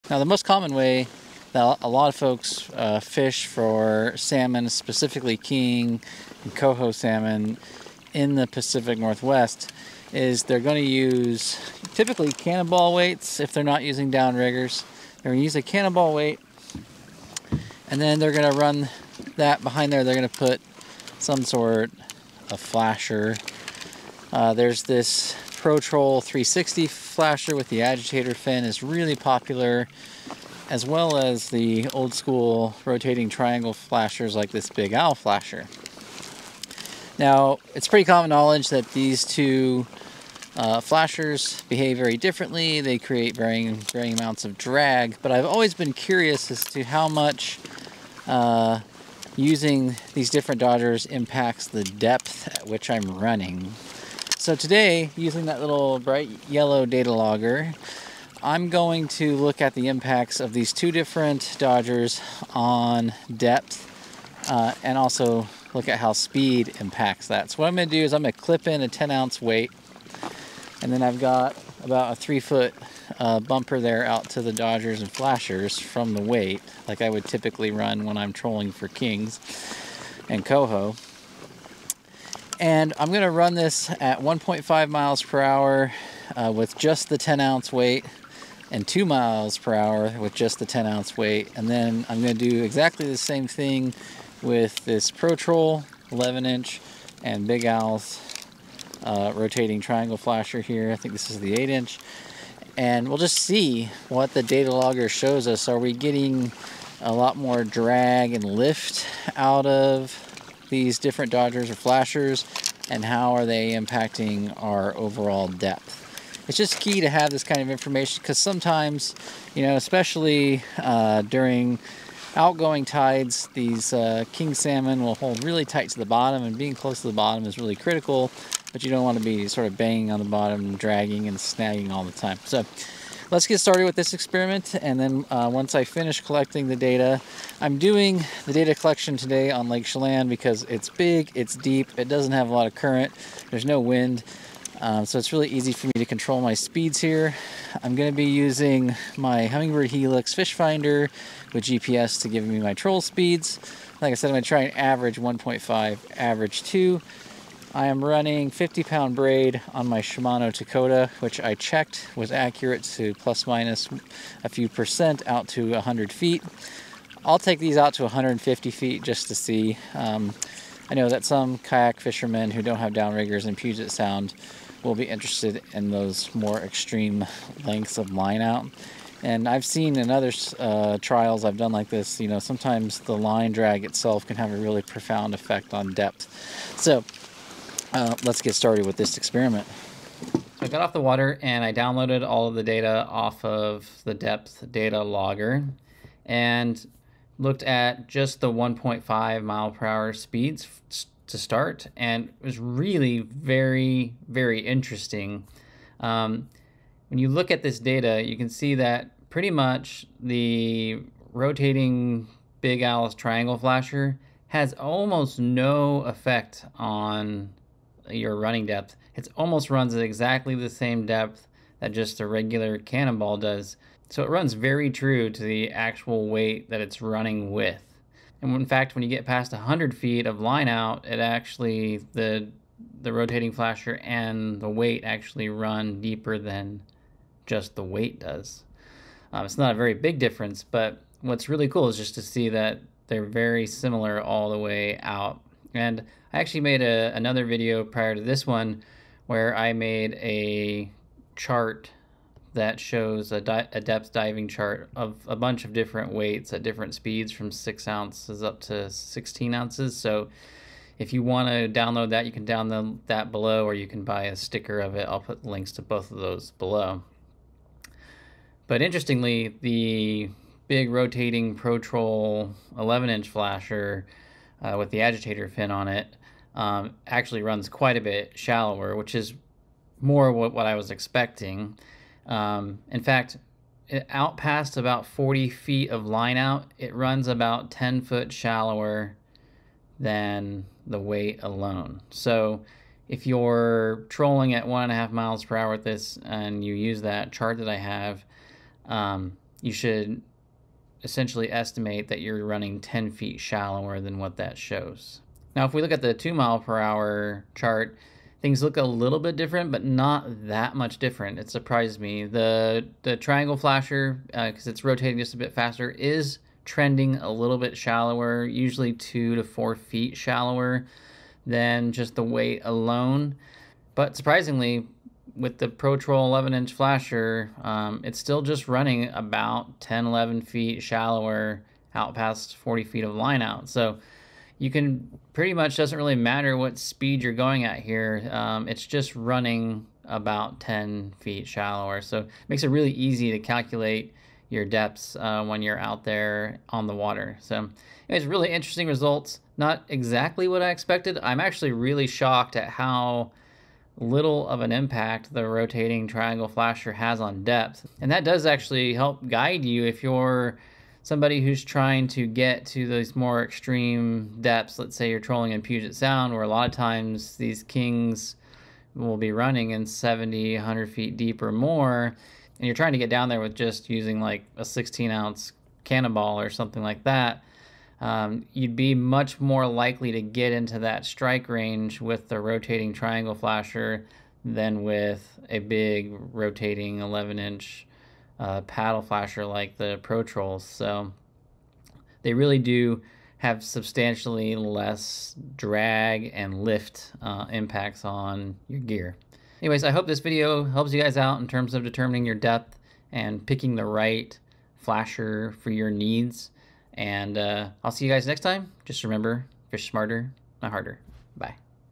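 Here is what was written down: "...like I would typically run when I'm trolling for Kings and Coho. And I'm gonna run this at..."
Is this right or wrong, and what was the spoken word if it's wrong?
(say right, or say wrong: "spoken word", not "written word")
right.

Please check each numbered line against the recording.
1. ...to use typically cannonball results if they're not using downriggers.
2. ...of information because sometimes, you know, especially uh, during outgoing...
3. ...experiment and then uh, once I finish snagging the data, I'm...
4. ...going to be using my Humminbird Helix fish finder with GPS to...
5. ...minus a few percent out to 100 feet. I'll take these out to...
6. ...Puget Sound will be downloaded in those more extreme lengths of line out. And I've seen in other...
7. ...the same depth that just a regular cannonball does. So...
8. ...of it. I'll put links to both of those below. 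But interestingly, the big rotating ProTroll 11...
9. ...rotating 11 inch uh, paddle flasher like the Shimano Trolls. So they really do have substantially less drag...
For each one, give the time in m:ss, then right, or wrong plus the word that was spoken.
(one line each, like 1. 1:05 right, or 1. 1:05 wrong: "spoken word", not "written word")
1. 0:10 wrong: "weights", not "results"
2. 1:57 right
3. 2:14 wrong: "collecting", not "snagging"
4. 2:27 right
5. 2:43 right
6. 2:53 wrong: "interested", not "downloaded"
7. 3:40 right
8. 4:24 right
9. 6:26 wrong: "Pro", not "Shimano".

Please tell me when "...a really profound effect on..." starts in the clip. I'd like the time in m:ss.
3:04.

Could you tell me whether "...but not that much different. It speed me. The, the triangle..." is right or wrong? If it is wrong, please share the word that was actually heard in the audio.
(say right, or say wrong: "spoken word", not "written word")
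wrong: "surprised", not "speed".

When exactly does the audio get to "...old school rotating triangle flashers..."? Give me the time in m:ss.
0:31.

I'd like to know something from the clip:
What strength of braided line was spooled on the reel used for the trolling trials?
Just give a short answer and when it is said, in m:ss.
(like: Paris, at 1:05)
50 pound, at 2:38.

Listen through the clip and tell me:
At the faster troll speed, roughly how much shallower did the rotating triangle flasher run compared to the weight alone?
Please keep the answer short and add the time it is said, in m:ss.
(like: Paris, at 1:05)
2 to 4 feet, at 5:18.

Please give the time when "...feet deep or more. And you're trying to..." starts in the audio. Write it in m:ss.
6:10.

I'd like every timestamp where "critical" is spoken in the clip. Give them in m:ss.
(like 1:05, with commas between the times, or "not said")
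2:07.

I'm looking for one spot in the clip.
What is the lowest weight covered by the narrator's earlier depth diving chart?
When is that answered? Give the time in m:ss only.
4:17.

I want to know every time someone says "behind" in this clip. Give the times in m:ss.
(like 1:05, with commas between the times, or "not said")
0:19.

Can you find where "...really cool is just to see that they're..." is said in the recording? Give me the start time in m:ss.
4:01.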